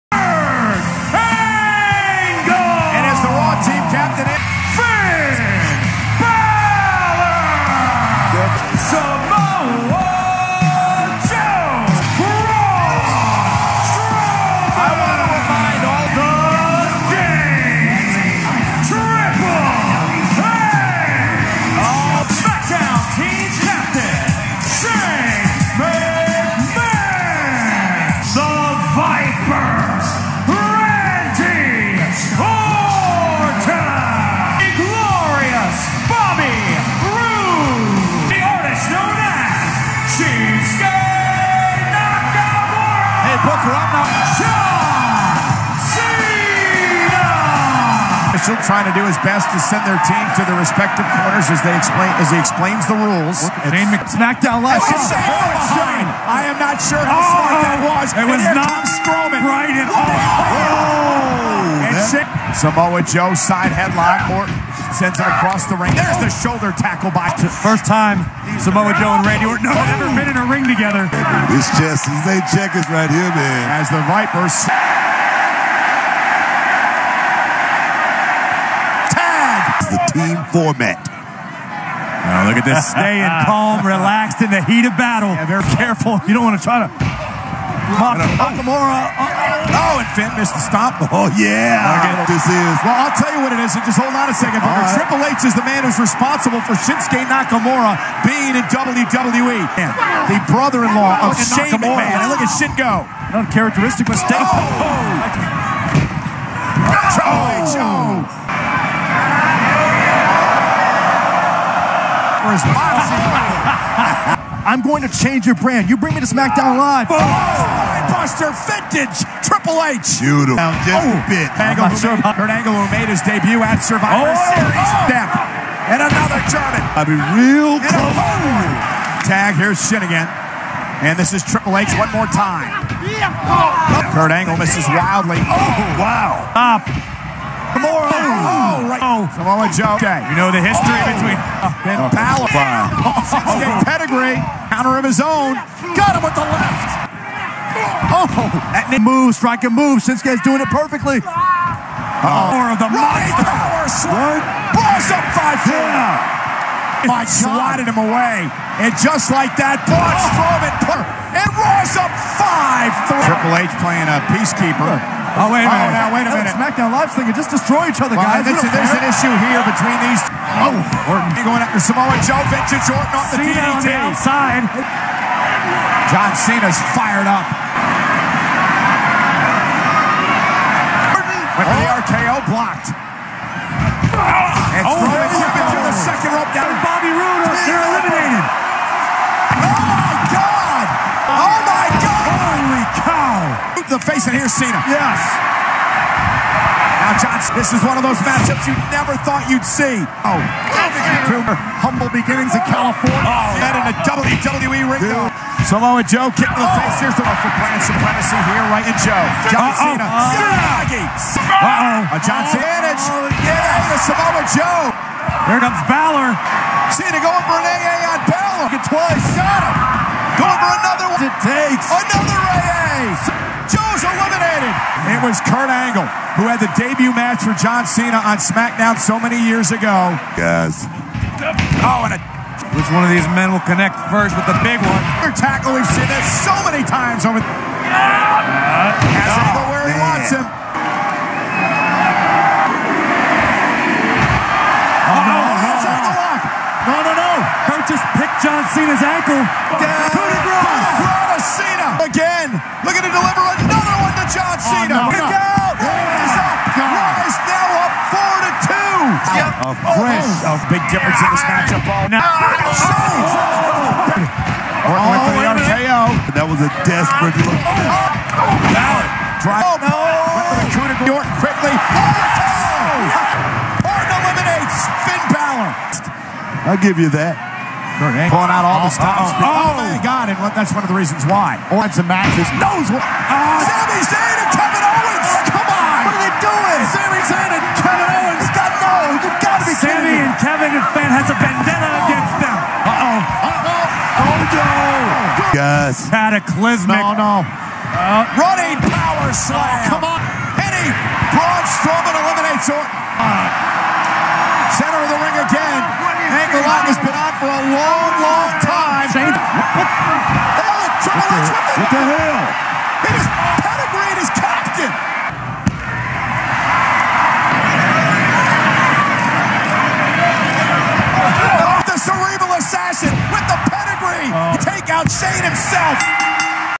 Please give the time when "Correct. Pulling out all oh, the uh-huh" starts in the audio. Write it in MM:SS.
04:38.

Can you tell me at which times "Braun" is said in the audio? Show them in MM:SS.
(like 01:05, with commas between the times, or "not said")
02:39, 05:01.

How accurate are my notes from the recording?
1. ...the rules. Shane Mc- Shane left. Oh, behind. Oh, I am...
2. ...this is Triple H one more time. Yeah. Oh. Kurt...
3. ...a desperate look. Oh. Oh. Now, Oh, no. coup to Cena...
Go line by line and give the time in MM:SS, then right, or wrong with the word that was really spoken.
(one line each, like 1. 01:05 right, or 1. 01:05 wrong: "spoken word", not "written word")
1. 00:52 wrong: "SmackDown", not "Shane"
2. 02:11 right
3. 04:26 wrong: "New", not "Cena".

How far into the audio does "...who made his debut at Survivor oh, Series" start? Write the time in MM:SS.
02:02.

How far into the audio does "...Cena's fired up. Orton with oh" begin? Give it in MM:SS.
02:56.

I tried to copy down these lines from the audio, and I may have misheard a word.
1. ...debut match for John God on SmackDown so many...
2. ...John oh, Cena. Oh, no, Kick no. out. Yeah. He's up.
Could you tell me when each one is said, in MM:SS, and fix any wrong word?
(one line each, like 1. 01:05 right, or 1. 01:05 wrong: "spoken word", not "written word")
1. 03:46 wrong: "Cena", not "God"
2. 04:14 right.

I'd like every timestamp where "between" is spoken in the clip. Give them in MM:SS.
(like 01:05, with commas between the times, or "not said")
02:21, 02:49.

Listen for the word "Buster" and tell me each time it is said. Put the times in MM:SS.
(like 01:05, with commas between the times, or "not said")
01:58.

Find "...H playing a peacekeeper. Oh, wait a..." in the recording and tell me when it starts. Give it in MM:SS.
02:43.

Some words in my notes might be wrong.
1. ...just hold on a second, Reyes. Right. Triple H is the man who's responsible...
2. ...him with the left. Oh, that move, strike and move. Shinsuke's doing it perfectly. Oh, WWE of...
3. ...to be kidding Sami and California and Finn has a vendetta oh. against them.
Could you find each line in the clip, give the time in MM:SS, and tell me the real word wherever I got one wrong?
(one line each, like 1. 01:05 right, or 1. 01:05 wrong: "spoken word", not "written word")
1. 01:33 wrong: "Booker", not "Reyes"
2. 02:26 wrong: "More", not "WWE"
3. 04:49 wrong: "Kevin", not "California".